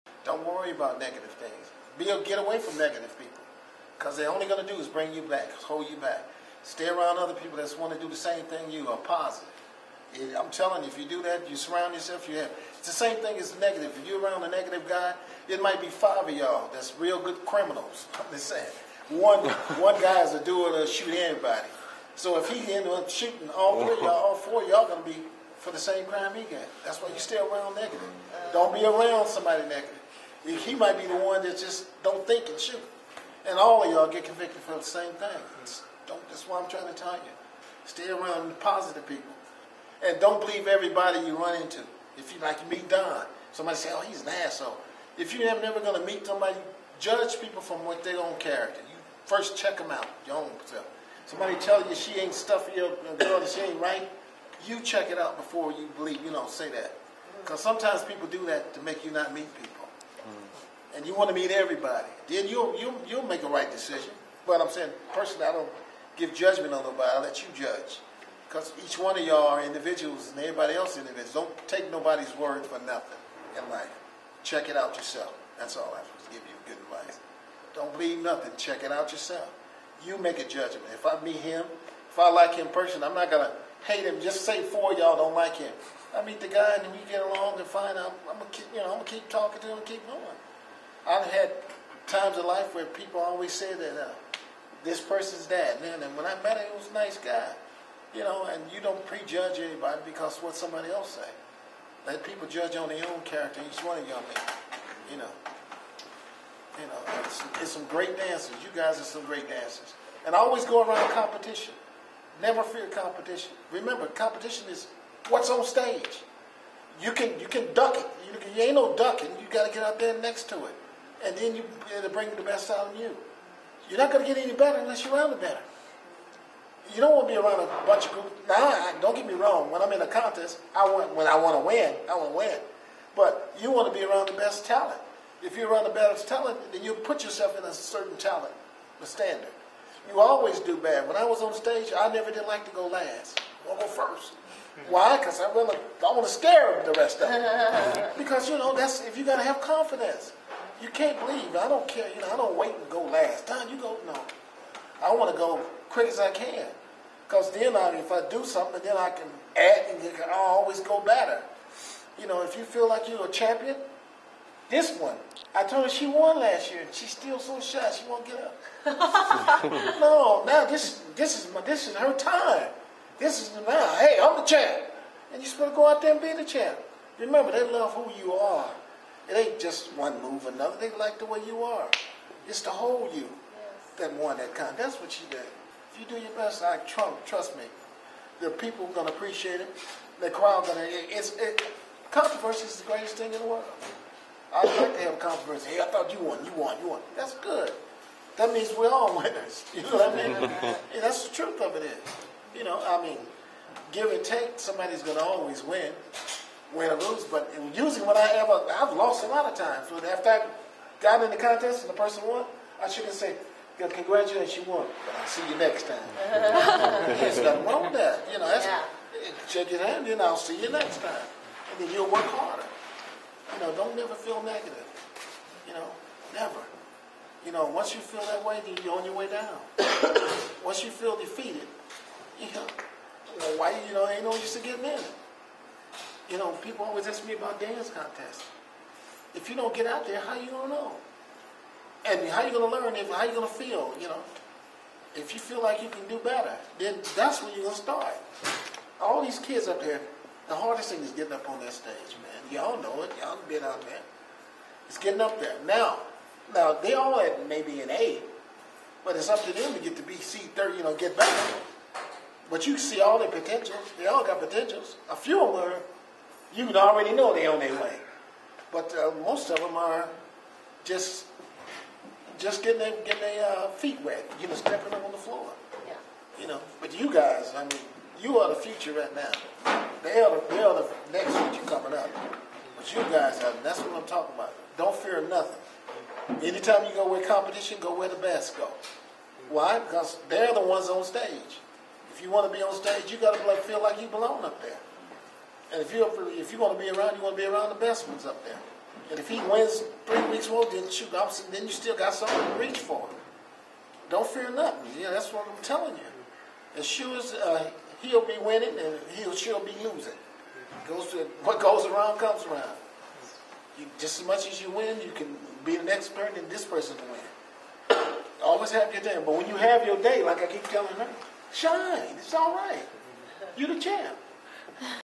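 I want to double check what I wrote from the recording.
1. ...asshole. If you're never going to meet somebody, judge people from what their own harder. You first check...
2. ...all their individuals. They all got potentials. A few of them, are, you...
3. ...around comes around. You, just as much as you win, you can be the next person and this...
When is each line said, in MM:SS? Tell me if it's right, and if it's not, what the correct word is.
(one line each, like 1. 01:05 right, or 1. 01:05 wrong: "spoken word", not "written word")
1. 00:44 wrong: "character", not "harder"
2. 04:22 wrong: "potentials", not "individuals"
3. 05:11 right.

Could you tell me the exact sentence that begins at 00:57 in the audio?
Because sometimes people do that to make you not meet people.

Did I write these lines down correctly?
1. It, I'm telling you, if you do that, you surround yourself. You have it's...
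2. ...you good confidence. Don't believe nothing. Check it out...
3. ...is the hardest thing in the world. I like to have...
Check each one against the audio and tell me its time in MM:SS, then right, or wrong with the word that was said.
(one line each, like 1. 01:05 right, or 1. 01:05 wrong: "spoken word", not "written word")
1. 00:10 right
2. 01:16 wrong: "advice", not "confidence"
3. 03:12 wrong: "greatest", not "hardest".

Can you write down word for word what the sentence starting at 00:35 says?
It's, don't, that's why I'm trying to tell you.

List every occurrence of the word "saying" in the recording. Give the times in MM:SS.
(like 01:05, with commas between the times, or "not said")
00:18, 01:04.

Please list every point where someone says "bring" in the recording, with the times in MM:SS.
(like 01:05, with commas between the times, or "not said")
00:04, 02:02.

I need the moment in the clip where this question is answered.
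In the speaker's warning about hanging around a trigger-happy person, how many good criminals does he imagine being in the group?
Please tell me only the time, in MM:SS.
00:15.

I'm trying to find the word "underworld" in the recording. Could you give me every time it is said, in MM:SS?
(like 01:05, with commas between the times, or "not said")
not said.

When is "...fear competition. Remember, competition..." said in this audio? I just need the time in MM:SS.
01:52.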